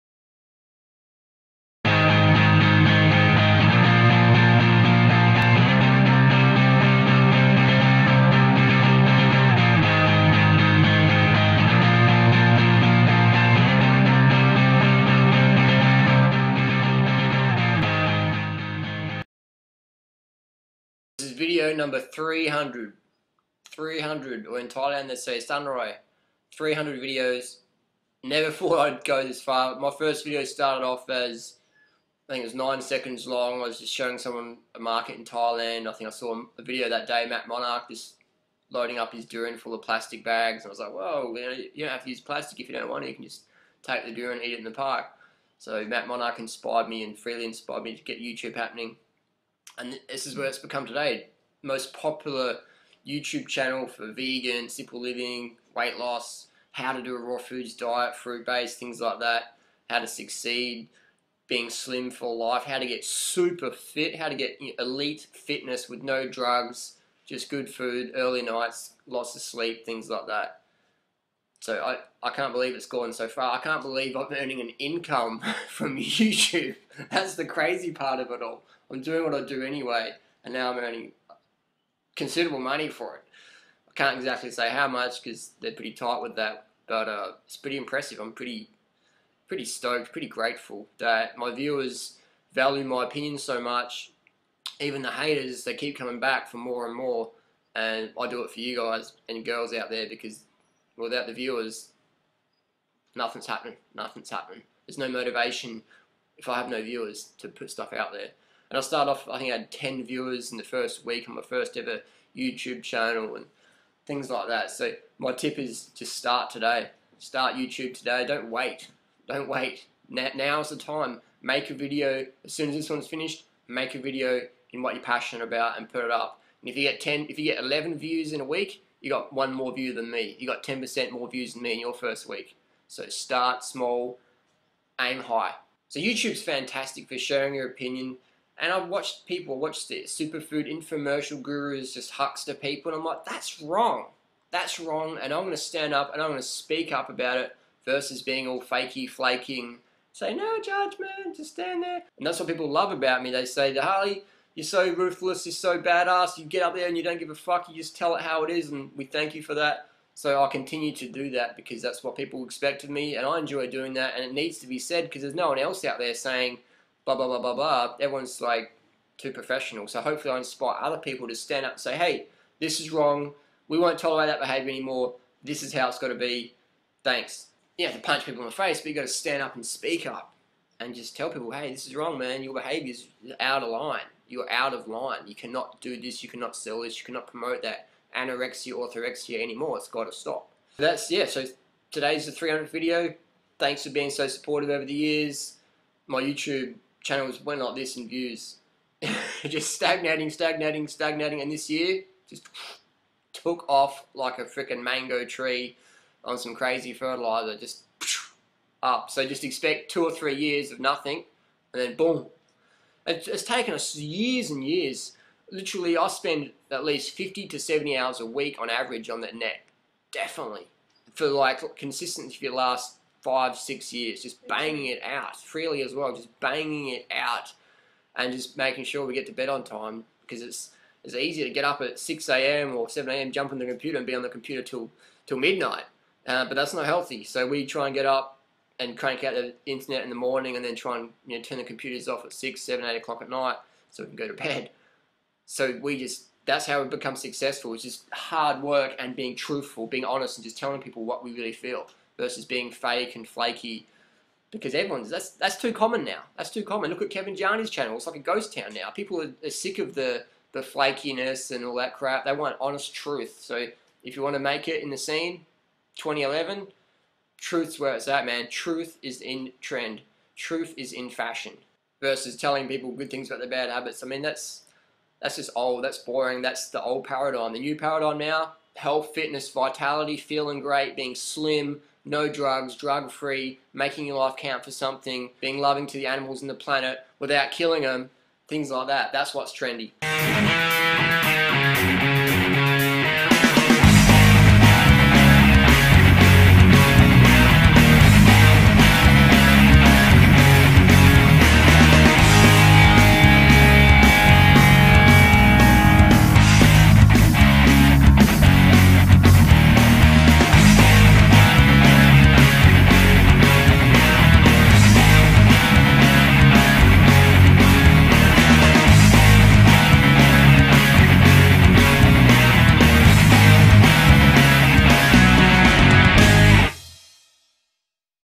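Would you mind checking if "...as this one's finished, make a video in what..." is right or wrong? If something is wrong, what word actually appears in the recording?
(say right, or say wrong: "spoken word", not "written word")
right.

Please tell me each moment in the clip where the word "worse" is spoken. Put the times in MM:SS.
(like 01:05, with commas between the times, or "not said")
not said.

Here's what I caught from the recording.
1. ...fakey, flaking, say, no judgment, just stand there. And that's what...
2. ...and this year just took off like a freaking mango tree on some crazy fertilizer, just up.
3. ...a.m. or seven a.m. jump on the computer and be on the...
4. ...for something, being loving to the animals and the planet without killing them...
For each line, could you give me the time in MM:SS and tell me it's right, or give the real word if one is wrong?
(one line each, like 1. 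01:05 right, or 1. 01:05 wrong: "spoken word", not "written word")
1. 02:28 right
2. 03:21 right
3. 03:52 right
4. 04:44 right.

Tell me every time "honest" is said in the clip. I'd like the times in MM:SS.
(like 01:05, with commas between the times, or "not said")
04:10, 04:22.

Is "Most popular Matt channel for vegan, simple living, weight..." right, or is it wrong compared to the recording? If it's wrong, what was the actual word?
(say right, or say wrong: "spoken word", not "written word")
wrong: "YouTube", not "Matt".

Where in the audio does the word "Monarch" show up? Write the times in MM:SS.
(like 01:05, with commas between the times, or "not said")
00:37, 00:46.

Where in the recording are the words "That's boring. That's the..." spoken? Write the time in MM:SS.
04:35.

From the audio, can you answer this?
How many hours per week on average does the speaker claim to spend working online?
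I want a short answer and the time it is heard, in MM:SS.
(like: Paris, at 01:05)
50 to 70 hours, at 03:37.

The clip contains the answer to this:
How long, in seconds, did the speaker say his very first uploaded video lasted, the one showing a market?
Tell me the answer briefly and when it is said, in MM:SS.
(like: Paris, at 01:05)
9 seconds, at 00:32.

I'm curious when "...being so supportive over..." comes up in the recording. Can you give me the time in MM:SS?
03:13.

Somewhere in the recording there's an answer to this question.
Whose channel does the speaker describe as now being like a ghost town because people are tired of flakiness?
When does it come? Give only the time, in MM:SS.
04:17.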